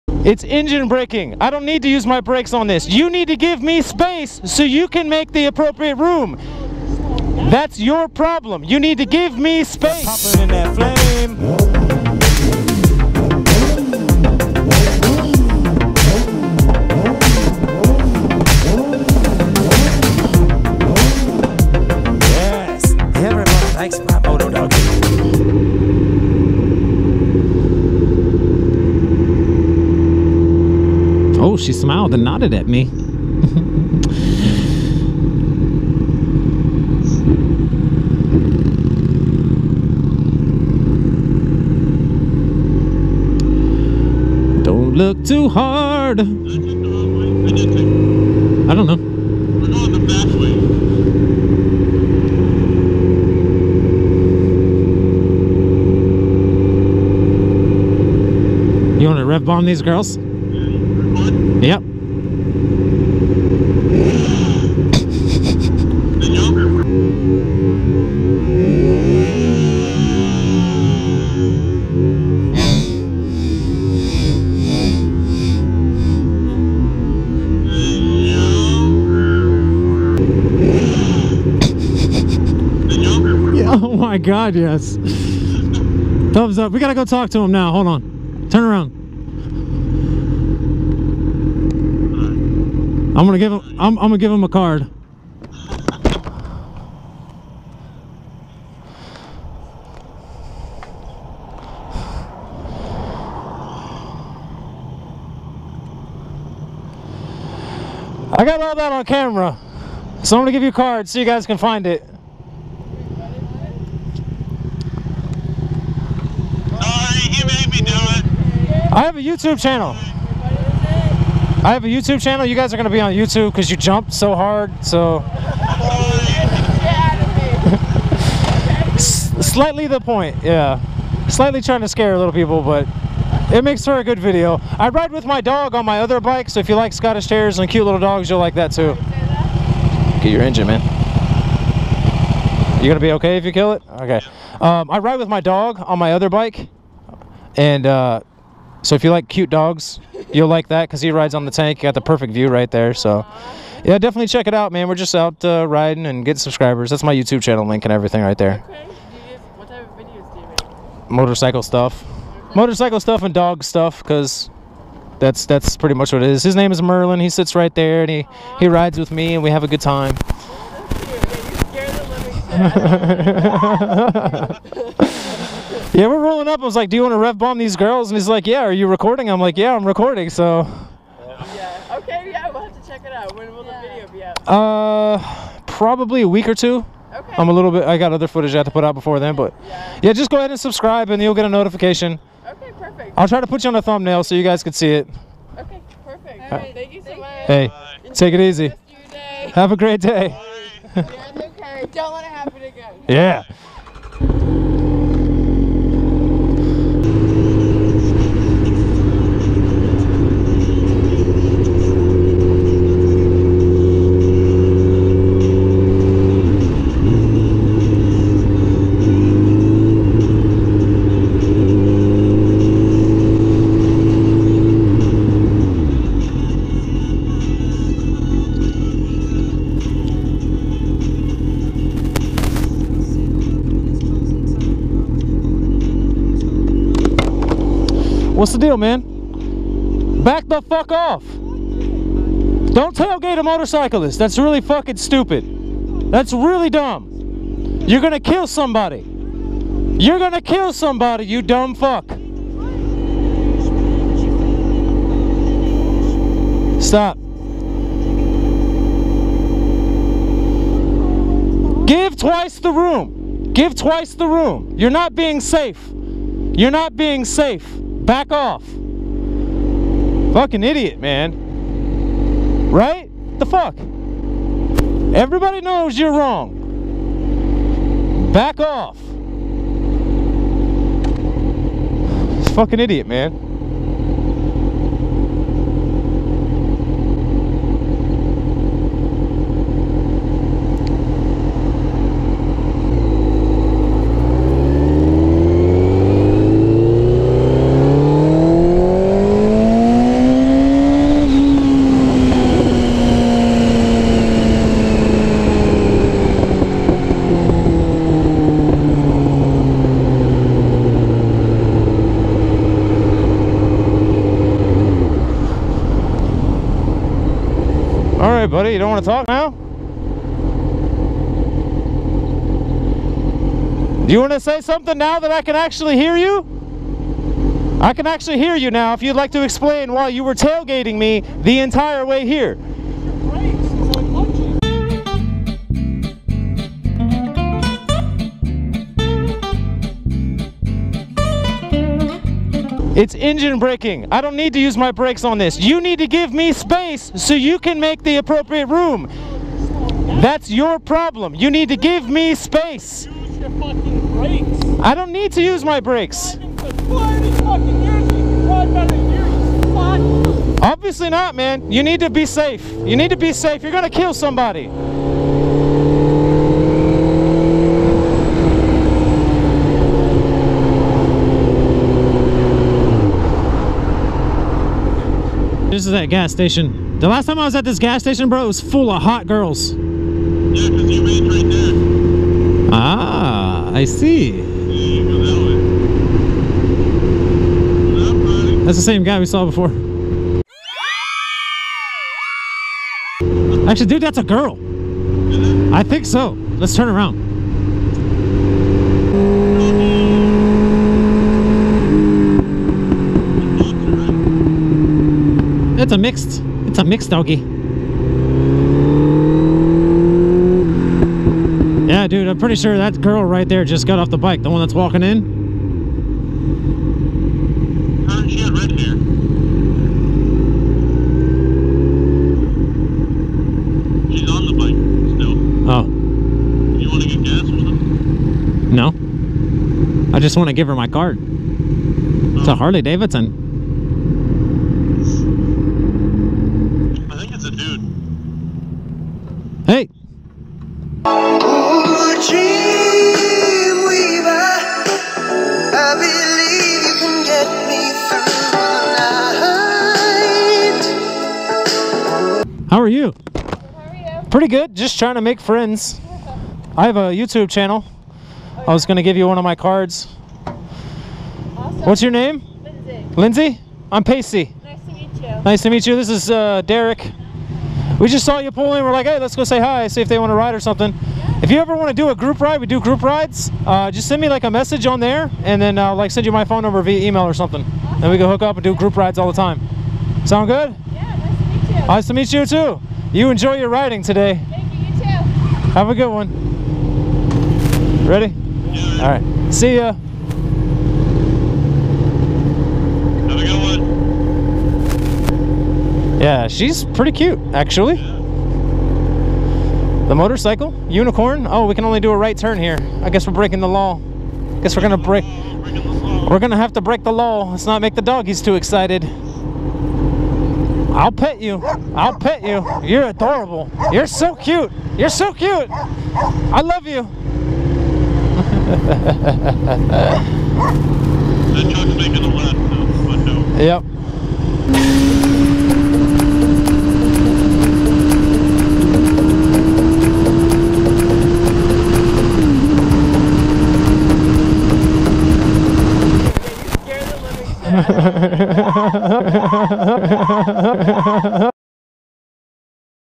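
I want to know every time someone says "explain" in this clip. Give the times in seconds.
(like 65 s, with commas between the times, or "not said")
329 s.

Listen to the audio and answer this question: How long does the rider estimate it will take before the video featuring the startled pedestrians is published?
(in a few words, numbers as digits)
a week or two.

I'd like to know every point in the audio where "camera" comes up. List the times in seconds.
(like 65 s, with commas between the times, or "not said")
109 s.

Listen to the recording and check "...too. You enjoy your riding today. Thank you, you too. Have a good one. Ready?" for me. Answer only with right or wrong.
right.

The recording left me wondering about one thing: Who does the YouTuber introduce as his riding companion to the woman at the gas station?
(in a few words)
Derek.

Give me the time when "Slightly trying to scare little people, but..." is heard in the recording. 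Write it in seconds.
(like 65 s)
131 s.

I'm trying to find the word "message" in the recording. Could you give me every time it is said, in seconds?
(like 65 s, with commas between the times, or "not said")
474 s.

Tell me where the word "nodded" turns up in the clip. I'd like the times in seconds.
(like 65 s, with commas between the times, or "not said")
32 s.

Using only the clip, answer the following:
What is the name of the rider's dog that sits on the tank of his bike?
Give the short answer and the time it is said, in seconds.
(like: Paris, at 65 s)
Merlin, at 166 s.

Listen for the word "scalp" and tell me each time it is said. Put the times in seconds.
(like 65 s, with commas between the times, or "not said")
not said.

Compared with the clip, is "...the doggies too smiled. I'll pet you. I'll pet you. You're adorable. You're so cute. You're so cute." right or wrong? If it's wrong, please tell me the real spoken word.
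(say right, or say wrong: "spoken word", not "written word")
wrong: "excited", not "smiled".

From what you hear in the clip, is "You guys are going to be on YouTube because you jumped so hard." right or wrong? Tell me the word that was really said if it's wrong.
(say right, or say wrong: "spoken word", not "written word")
right.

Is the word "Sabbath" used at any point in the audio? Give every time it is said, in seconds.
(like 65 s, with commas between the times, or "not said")
not said.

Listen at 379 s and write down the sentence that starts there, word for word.
Yeah, because you made right there.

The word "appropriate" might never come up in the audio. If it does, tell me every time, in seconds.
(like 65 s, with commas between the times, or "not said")
5 s, 348 s.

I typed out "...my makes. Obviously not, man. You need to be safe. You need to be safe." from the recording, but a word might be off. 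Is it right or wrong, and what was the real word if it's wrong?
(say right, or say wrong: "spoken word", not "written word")
wrong: "brakes", not "makes".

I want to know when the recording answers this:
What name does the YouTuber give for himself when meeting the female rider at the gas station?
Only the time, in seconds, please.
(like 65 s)
464 s.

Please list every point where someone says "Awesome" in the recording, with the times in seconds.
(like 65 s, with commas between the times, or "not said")
461 s, 477 s.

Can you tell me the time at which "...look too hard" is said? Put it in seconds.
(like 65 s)
44 s.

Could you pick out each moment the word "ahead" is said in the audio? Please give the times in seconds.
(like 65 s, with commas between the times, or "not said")
190 s.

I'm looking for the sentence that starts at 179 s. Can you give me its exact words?
I'm like, yeah, I'm recording, so.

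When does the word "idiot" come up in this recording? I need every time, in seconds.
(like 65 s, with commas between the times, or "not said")
270 s, 282 s.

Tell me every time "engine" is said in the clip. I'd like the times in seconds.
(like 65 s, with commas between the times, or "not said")
0 s, 140 s, 343 s.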